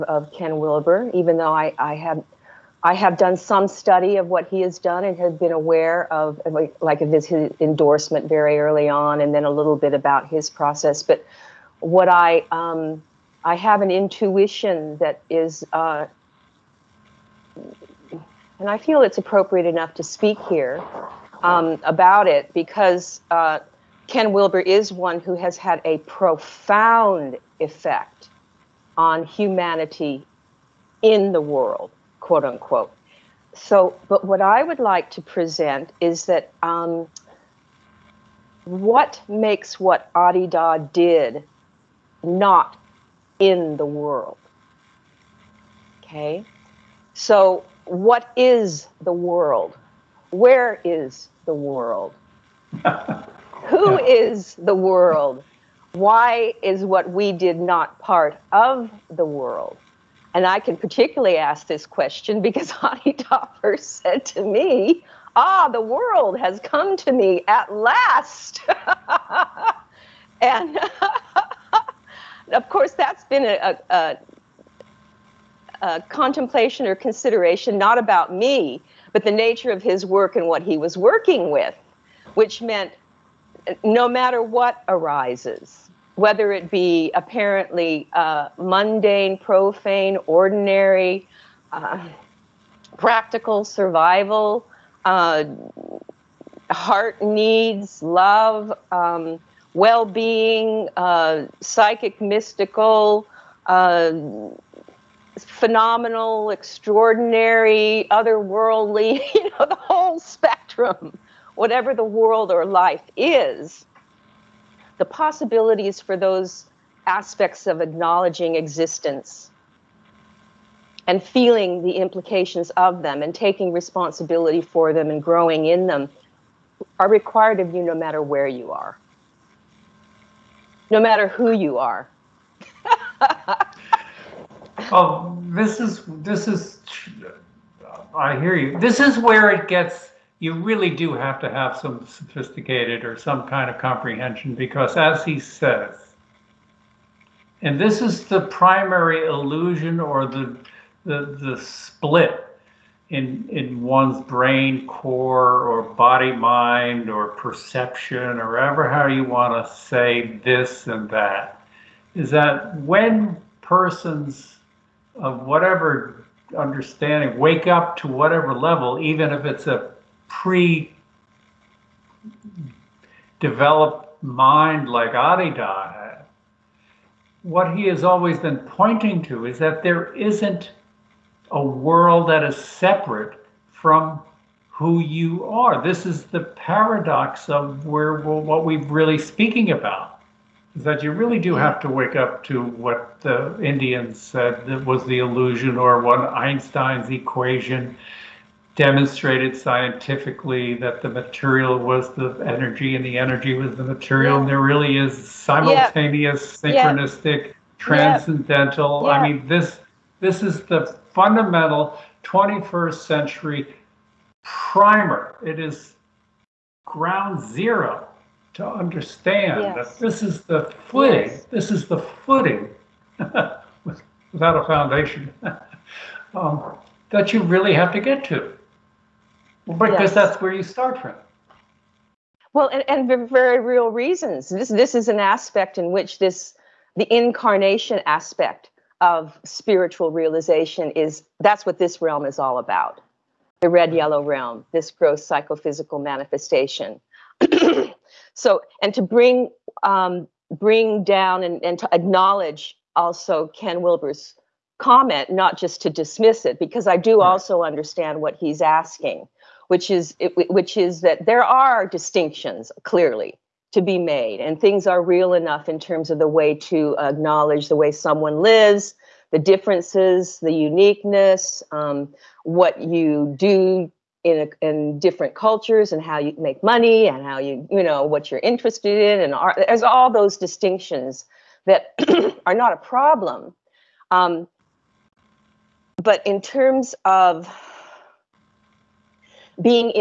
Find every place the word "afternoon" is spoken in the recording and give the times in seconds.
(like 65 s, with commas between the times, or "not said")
not said.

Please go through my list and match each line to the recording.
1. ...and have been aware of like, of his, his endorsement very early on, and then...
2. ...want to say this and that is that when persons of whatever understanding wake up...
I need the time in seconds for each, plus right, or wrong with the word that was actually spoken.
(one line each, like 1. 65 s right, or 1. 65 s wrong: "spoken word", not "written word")
1. 5 s right
2. 159 s right.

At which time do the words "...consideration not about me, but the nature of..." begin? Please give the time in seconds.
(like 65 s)
76 s.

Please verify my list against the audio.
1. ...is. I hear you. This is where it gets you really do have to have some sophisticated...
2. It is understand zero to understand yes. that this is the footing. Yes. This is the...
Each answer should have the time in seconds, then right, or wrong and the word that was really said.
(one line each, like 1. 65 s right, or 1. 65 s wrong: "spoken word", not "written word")
1. 136 s right
2. 215 s wrong: "ground", not "understand".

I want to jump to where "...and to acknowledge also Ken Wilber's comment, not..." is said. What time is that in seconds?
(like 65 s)
251 s.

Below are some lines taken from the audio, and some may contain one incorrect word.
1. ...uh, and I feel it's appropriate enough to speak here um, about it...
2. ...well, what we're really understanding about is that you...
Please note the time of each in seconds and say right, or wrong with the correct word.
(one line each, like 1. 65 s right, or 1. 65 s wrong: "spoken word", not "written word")
1. 15 s right
2. 188 s wrong: "speaking", not "understanding".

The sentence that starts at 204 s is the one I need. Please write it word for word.
And there really is simultaneous, synchronistic, transcendental.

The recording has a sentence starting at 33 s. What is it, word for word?
So, but what I would like to present is that um, what makes what Adi Da did not in the world?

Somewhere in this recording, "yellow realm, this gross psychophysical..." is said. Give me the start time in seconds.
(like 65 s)
243 s.